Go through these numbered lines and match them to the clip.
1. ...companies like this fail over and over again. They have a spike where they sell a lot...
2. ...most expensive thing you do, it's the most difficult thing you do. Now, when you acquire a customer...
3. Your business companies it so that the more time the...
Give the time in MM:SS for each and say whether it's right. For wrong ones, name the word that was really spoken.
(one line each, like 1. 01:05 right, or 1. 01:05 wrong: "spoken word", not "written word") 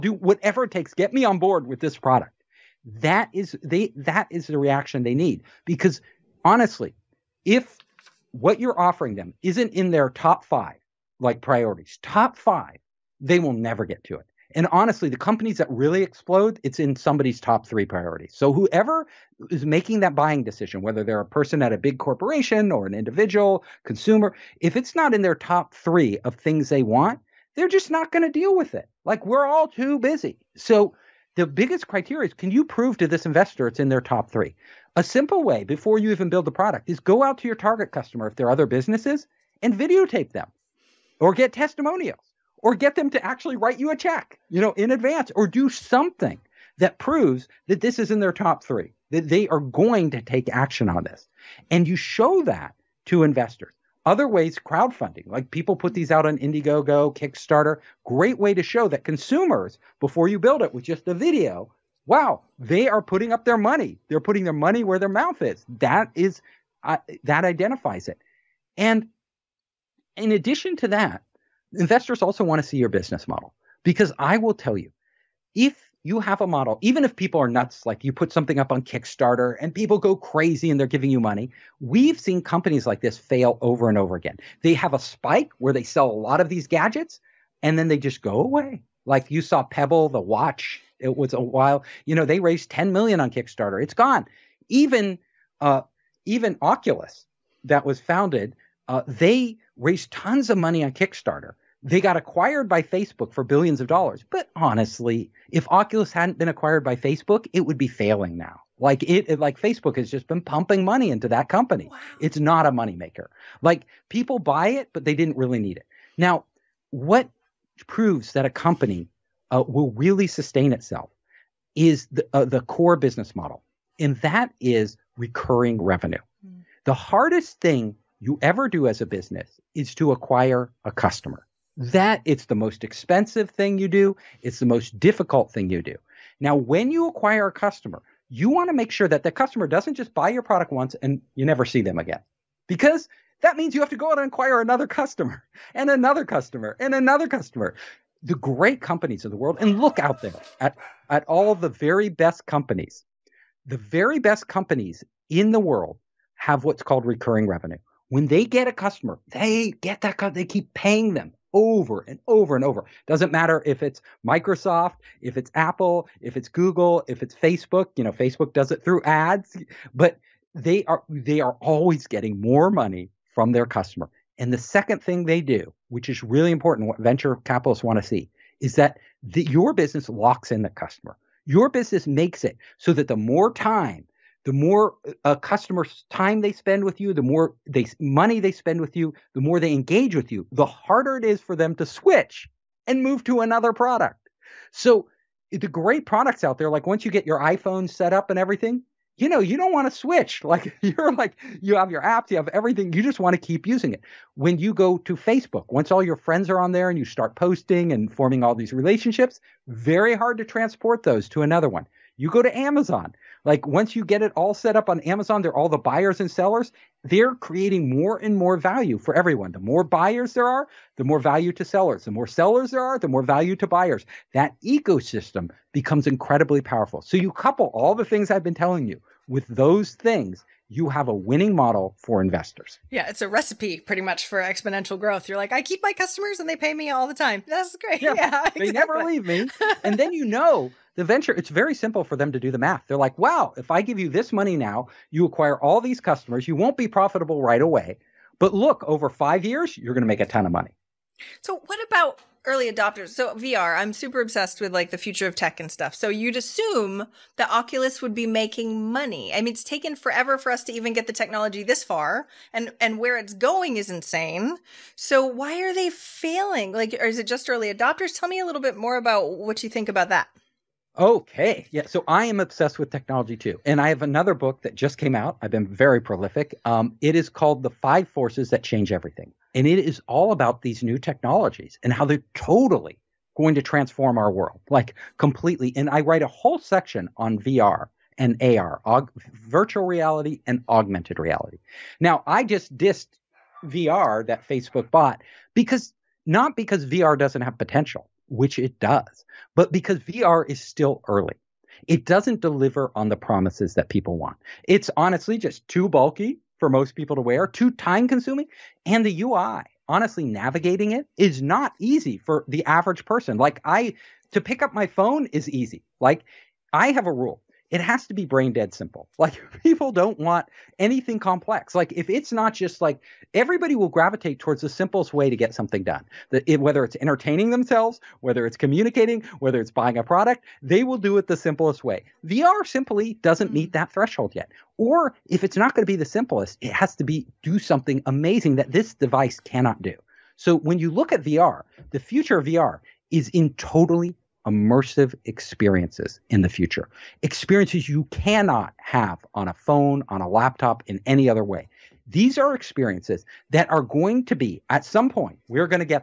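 1. 01:22 right
2. 02:12 right
3. 03:01 wrong: "makes", not "companies".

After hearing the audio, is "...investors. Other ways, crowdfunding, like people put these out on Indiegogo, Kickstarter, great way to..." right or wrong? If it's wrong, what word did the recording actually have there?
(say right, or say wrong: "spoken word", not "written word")
right.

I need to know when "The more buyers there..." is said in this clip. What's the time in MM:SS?
03:39.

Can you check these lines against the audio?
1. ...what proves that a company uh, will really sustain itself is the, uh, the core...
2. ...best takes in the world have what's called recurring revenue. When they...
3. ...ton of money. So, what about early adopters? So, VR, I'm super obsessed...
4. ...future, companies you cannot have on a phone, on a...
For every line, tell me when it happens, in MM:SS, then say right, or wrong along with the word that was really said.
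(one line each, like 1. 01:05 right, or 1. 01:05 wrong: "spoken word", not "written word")
1. 01:56 right
2. 02:34 wrong: "companies", not "takes"
3. 04:10 right
4. 05:46 wrong: "experiences", not "companies".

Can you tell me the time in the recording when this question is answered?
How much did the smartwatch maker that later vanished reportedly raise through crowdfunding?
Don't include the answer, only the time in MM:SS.
01:32.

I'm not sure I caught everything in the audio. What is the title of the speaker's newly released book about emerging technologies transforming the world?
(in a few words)
The Five Forces That Change Everything.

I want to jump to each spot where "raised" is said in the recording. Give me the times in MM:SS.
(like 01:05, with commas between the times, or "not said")
01:32, 01:39.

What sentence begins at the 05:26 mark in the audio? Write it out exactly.
The, it, whether it's entertaining themselves, whether it's communicating, whether it's buying a product, they will do it the simplest way.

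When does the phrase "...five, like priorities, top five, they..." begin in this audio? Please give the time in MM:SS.
00:10.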